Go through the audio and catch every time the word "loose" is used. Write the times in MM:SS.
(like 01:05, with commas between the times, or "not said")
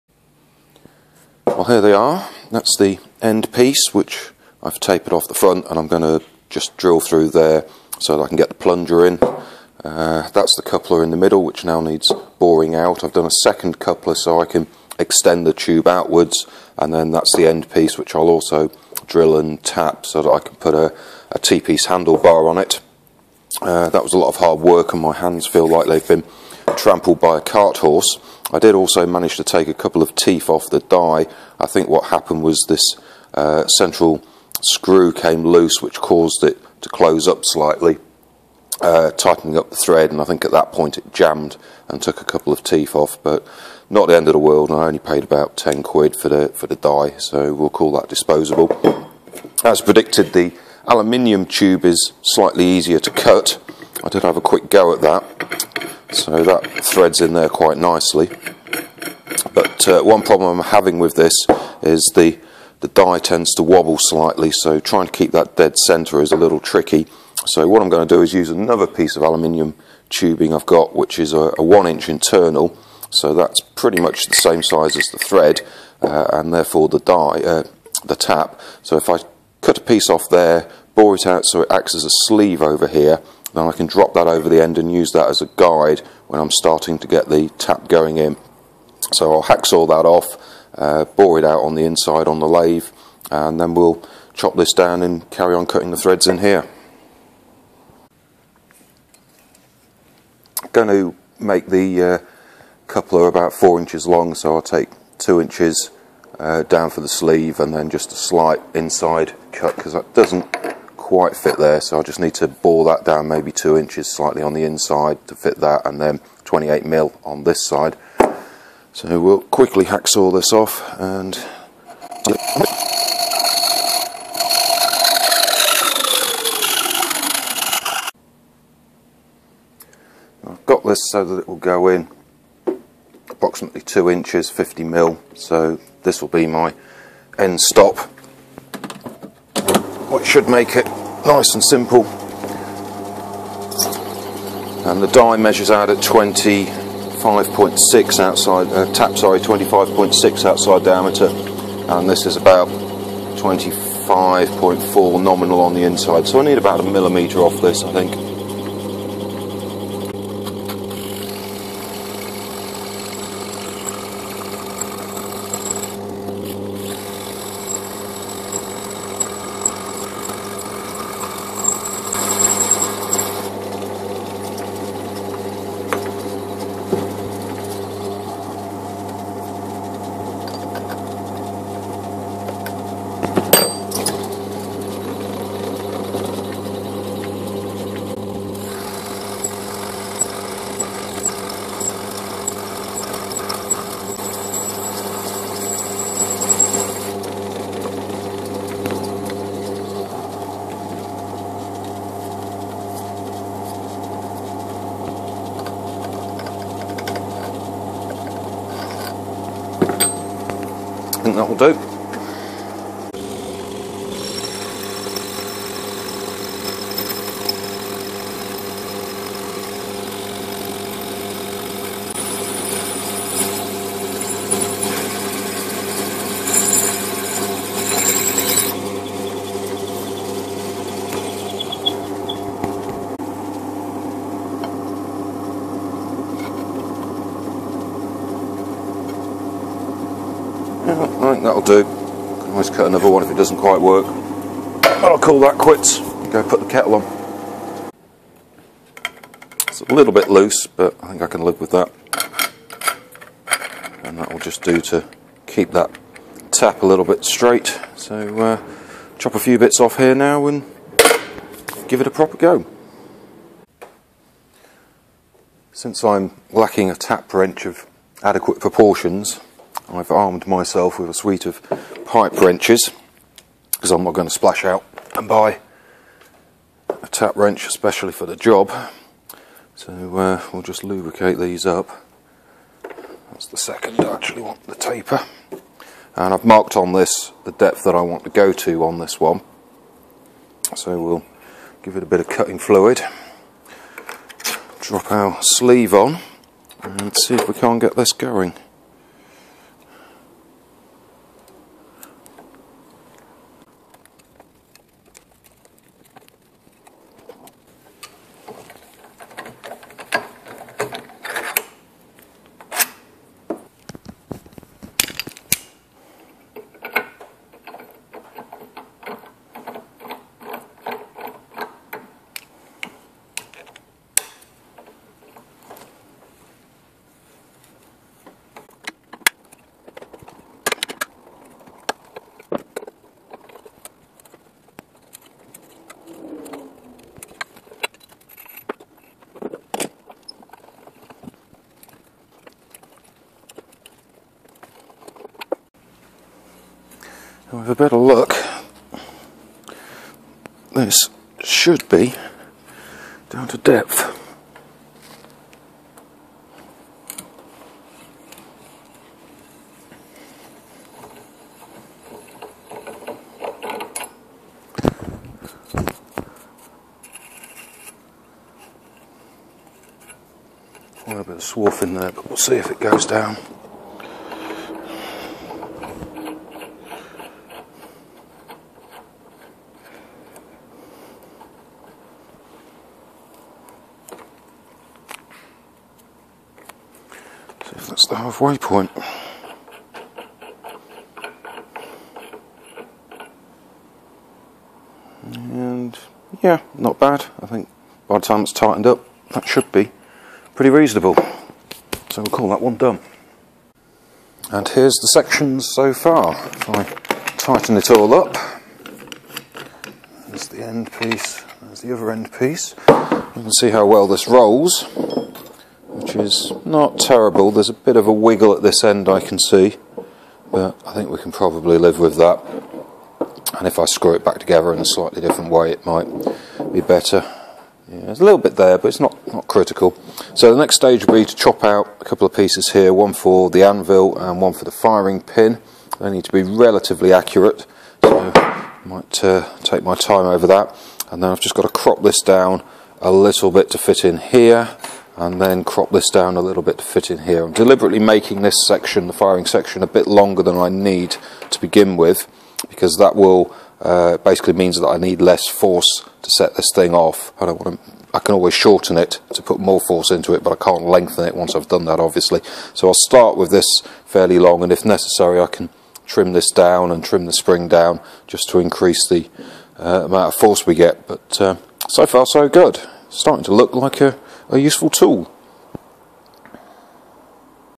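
00:35, 04:10.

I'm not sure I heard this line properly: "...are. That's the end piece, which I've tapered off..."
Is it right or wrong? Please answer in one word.
right.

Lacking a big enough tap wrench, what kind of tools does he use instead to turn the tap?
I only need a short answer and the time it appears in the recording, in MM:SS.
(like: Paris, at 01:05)
pipe wrenches, at 04:32.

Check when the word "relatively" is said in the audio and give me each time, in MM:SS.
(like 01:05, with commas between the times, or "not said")
07:16.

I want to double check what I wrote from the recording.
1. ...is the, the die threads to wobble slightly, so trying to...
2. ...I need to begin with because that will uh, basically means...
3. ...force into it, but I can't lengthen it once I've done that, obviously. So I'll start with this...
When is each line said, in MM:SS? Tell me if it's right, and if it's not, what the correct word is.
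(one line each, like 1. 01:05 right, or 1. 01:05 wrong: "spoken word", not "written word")
1. 01:01 wrong: "tends", not "threads"
2. 07:30 right
3. 07:39 right.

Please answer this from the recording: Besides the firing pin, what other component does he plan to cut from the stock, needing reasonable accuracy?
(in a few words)
anvil.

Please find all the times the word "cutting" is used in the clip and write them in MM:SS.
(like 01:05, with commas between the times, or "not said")
01:35, 04:52.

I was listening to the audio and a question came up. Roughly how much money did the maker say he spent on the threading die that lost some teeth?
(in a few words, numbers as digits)
£10.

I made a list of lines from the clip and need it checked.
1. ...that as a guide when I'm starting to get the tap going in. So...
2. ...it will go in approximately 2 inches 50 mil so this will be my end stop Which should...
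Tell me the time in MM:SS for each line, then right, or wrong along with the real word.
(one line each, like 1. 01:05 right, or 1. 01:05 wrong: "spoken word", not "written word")
1. 01:25 right
2. 02:11 right.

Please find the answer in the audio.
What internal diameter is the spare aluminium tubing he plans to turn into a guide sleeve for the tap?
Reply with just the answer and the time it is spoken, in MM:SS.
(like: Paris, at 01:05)
1 inch, at 01:11.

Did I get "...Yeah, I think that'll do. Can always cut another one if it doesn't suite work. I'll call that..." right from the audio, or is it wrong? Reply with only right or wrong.
wrong.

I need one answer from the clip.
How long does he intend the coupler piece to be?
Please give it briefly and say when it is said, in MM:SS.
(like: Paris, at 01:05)
4 inches, at 01:43.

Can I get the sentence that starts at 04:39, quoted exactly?
So uh, we'll just lubricate these up.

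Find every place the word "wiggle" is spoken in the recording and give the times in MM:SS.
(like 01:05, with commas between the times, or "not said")
06:58.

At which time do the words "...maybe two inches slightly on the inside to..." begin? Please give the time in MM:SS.
01:53.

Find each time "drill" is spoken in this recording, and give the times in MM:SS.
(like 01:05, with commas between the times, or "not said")
00:06, 00:19.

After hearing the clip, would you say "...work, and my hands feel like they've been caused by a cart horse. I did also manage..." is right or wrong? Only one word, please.
wrong.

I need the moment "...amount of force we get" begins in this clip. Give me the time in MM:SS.
07:50.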